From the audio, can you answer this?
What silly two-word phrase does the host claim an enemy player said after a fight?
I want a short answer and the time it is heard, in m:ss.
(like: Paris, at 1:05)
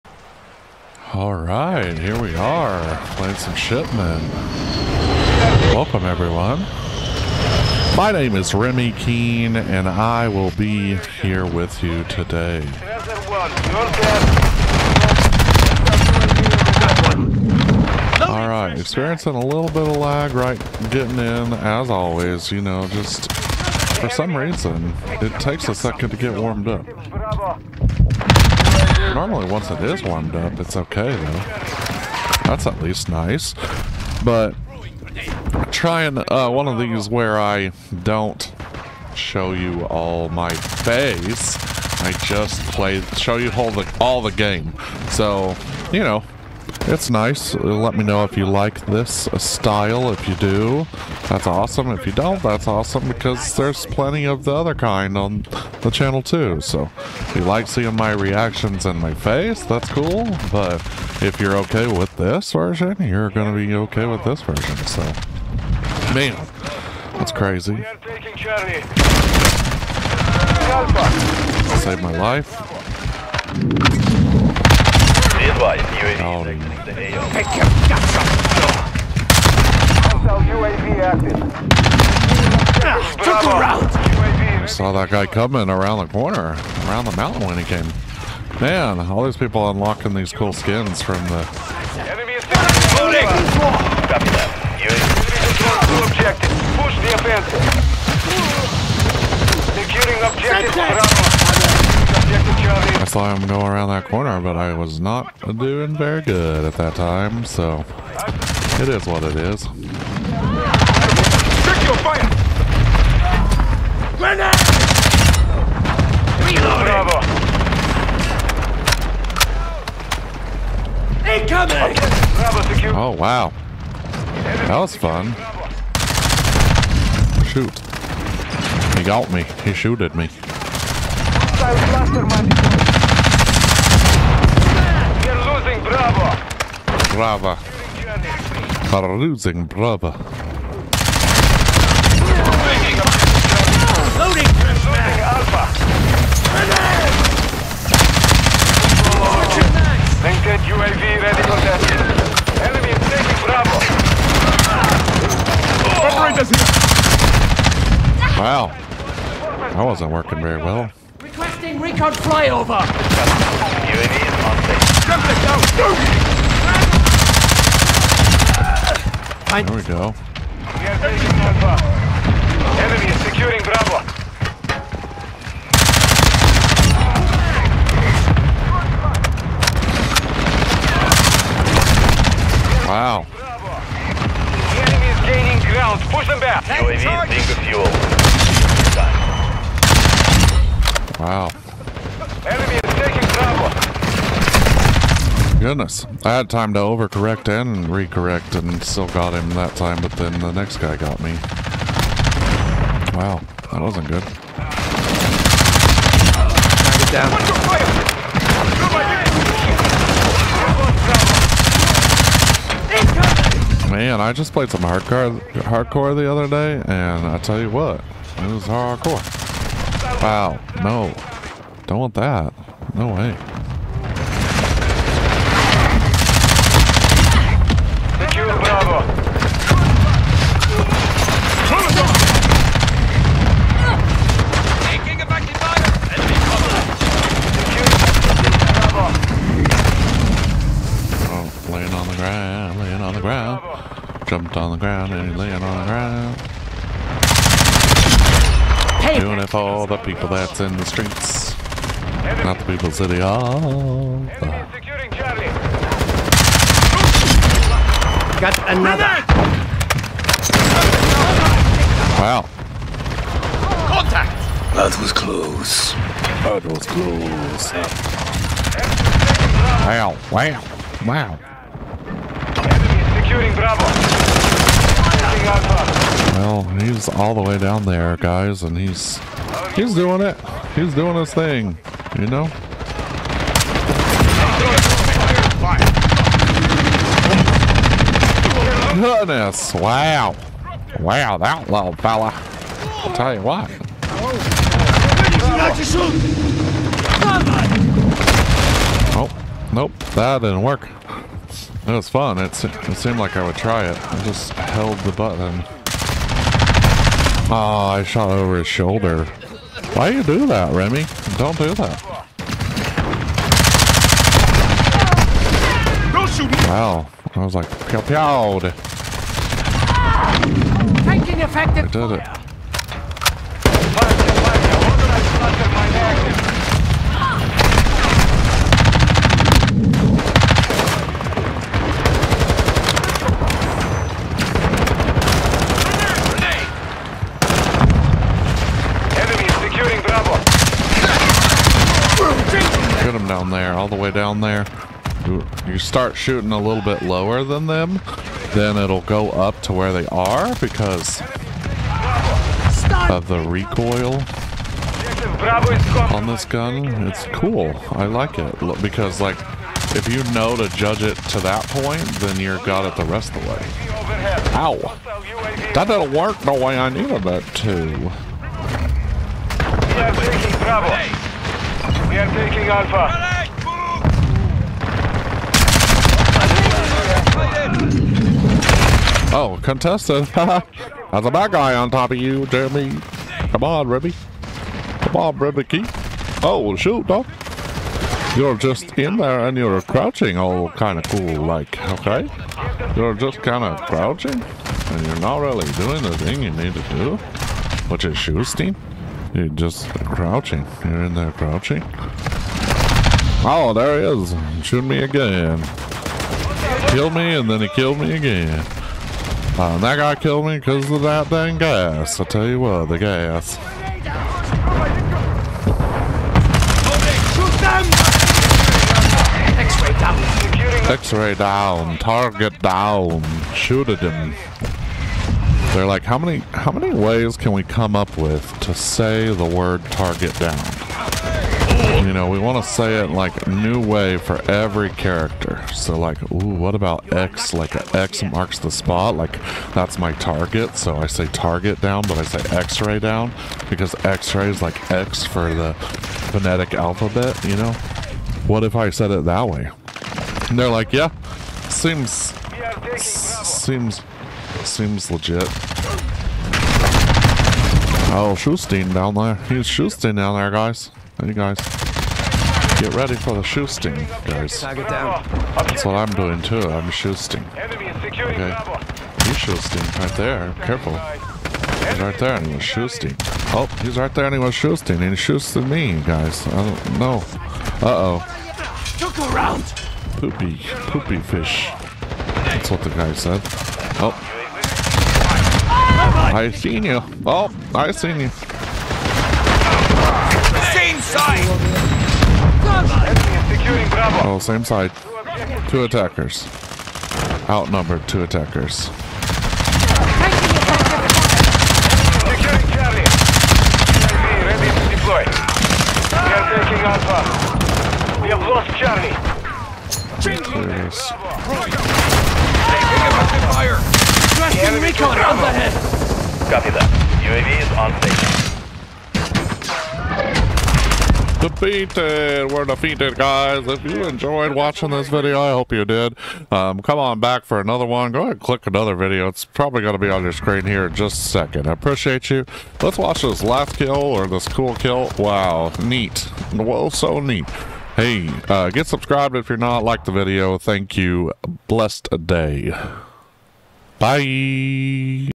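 Poopy fish, at 8:00.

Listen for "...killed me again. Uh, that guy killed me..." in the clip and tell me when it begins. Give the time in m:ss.
6:47.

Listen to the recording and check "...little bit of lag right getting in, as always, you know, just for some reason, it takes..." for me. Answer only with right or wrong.
right.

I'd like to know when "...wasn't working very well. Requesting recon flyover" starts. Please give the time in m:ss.
2:39.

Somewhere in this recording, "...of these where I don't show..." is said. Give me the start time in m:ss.
0:36.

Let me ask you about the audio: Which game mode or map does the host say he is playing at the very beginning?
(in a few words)
Shipment.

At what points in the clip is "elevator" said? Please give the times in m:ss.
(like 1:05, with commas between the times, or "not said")
not said.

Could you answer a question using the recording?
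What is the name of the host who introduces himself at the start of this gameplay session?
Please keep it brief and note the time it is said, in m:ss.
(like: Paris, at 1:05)
Remy Keene, at 0:08.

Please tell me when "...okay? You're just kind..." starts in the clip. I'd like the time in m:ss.
6:31.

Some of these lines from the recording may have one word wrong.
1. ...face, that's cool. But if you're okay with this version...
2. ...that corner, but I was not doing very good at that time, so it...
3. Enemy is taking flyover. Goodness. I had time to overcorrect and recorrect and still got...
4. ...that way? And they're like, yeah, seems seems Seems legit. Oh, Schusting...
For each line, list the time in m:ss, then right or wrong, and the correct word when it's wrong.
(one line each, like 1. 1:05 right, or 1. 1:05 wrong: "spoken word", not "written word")
1. 0:59 right
2. 1:43 right
3. 3:12 wrong: "cover", not "flyover"
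4. 7:29 right.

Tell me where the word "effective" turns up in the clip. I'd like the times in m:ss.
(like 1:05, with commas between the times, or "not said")
5:21, 8:33.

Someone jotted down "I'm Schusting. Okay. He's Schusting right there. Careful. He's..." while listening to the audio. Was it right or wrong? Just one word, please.
right.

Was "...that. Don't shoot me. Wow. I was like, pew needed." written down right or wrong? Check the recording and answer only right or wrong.
wrong.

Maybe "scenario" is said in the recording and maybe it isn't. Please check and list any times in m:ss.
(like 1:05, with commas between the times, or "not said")
not said.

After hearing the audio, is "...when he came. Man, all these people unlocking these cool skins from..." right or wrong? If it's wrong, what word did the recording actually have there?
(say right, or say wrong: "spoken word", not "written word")
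right.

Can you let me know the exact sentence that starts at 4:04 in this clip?
Jumped on the ground and laying on the ground.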